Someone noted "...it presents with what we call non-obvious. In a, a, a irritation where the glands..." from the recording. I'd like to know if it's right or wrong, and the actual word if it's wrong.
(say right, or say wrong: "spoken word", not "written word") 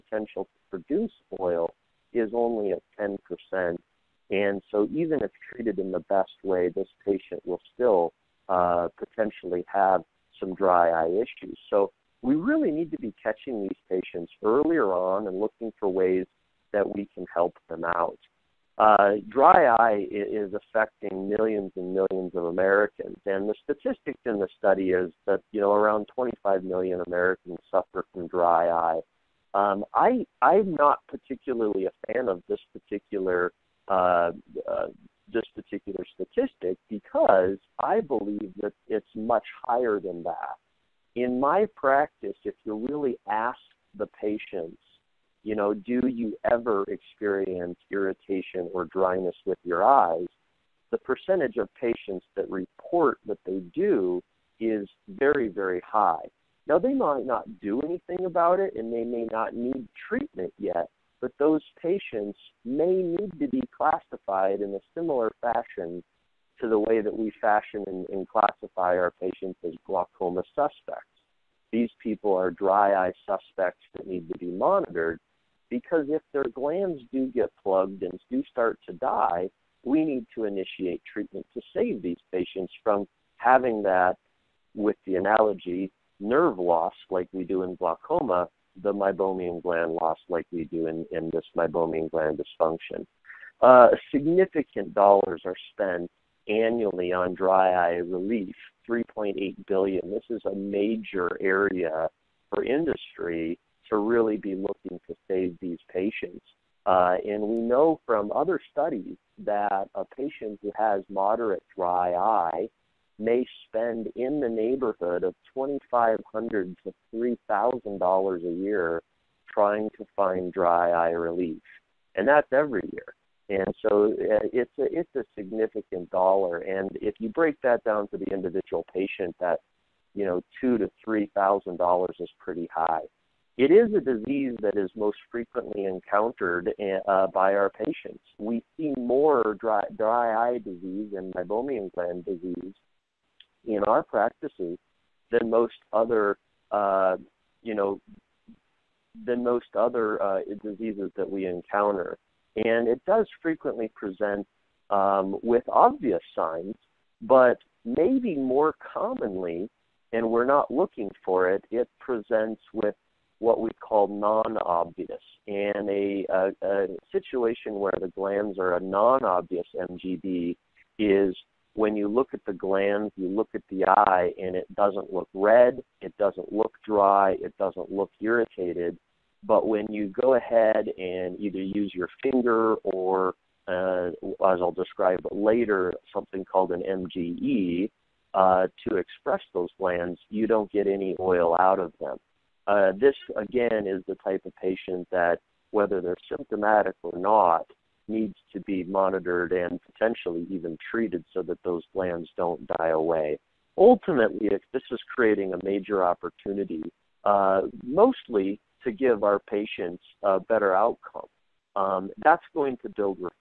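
wrong: "situation", not "irritation".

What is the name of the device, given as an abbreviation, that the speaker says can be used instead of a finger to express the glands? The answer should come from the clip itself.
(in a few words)
MGE.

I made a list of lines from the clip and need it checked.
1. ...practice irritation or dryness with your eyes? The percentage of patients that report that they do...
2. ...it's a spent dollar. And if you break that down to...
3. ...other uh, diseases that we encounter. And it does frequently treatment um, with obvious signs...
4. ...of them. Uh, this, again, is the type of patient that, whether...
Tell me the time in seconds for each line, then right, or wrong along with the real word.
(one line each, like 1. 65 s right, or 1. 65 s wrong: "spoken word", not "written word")
1. 46 s wrong: "experience", not "practice"
2. 124 s wrong: "significant", not "spent"
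3. 149 s wrong: "present", not "treatment"
4. 191 s right.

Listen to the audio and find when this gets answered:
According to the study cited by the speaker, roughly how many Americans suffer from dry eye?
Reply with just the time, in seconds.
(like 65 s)
26 s.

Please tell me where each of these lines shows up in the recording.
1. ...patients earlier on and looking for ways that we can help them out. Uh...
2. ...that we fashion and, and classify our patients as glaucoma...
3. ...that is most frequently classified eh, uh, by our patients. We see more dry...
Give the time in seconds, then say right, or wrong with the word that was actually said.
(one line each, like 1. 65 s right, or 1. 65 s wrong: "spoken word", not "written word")
1. 13 s right
2. 67 s right
3. 134 s wrong: "encountered", not "classified".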